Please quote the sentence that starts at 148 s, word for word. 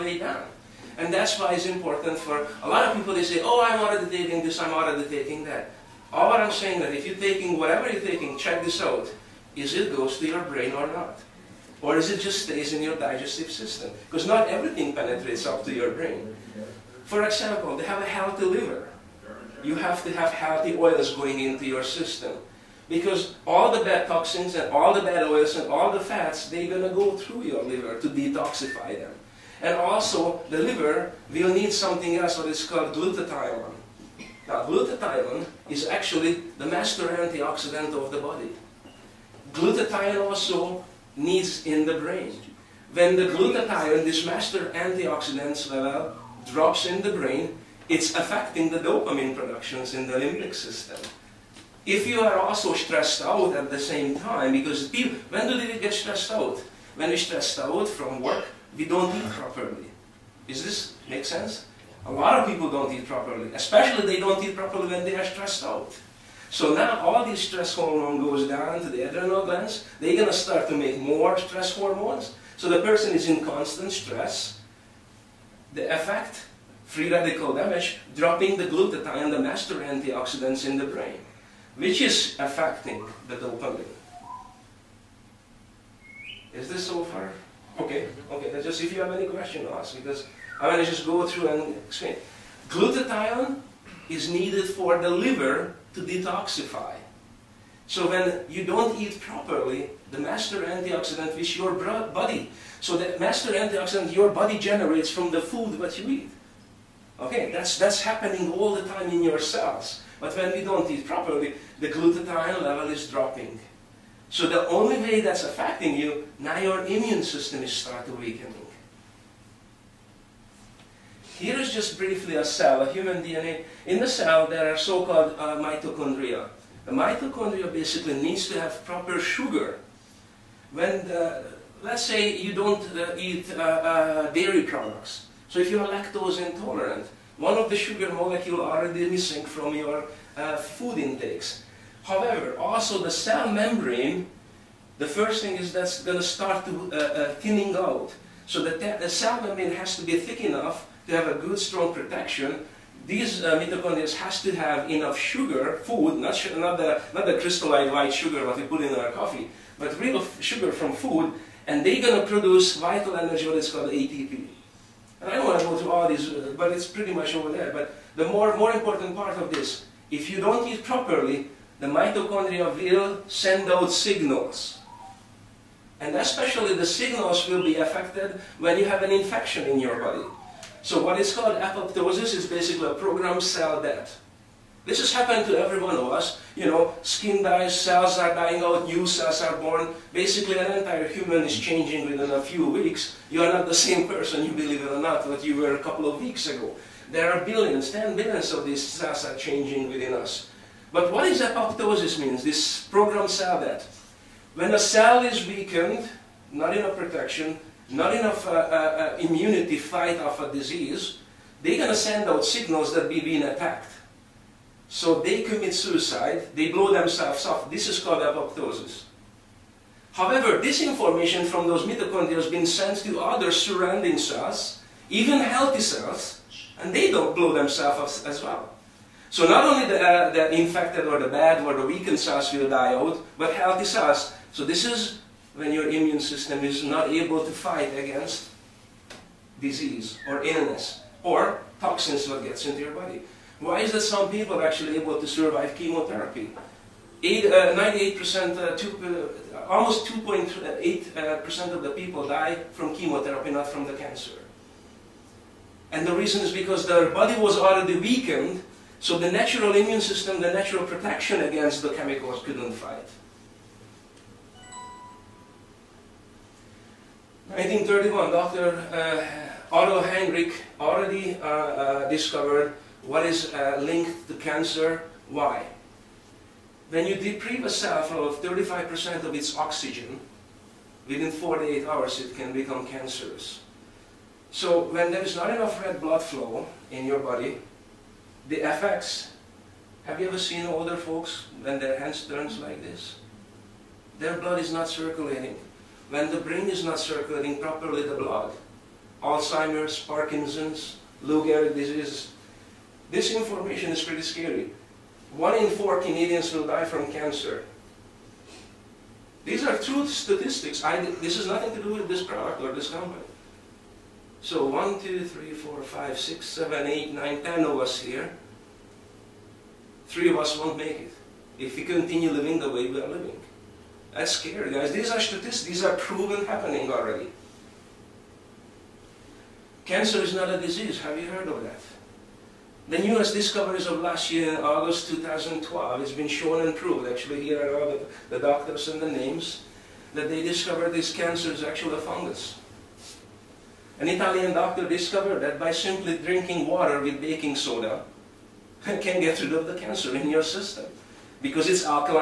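So the, the, cell membrane has to be thick enough to have a good, strong protection.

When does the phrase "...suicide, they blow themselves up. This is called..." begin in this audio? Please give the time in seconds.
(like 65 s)
215 s.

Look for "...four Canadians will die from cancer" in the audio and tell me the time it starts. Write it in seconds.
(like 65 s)
305 s.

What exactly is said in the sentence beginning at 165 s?
And I don't want to go through all these, uh, but it's pretty much over there.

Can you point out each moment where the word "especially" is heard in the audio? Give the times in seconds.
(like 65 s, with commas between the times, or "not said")
63 s, 176 s.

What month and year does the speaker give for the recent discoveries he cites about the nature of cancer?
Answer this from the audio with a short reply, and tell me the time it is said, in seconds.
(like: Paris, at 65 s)
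August 2012, at 334 s.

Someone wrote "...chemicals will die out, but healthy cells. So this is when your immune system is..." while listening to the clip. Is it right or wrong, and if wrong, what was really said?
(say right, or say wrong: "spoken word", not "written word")
wrong: "cells", not "chemicals".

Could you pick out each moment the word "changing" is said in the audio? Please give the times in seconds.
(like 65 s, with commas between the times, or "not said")
191 s, 199 s.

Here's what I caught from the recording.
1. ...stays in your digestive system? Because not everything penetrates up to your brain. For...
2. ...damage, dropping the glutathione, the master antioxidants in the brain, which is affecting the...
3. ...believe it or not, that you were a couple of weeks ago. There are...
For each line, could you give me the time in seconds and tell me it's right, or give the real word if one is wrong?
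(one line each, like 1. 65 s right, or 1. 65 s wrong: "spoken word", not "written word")
1. 12 s right
2. 77 s right
3. 194 s right.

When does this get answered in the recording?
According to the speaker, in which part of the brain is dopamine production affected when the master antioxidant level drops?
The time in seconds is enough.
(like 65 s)
50 s.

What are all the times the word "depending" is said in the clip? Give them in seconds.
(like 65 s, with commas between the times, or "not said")
not said.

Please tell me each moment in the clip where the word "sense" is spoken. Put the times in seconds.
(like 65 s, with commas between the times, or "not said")
61 s.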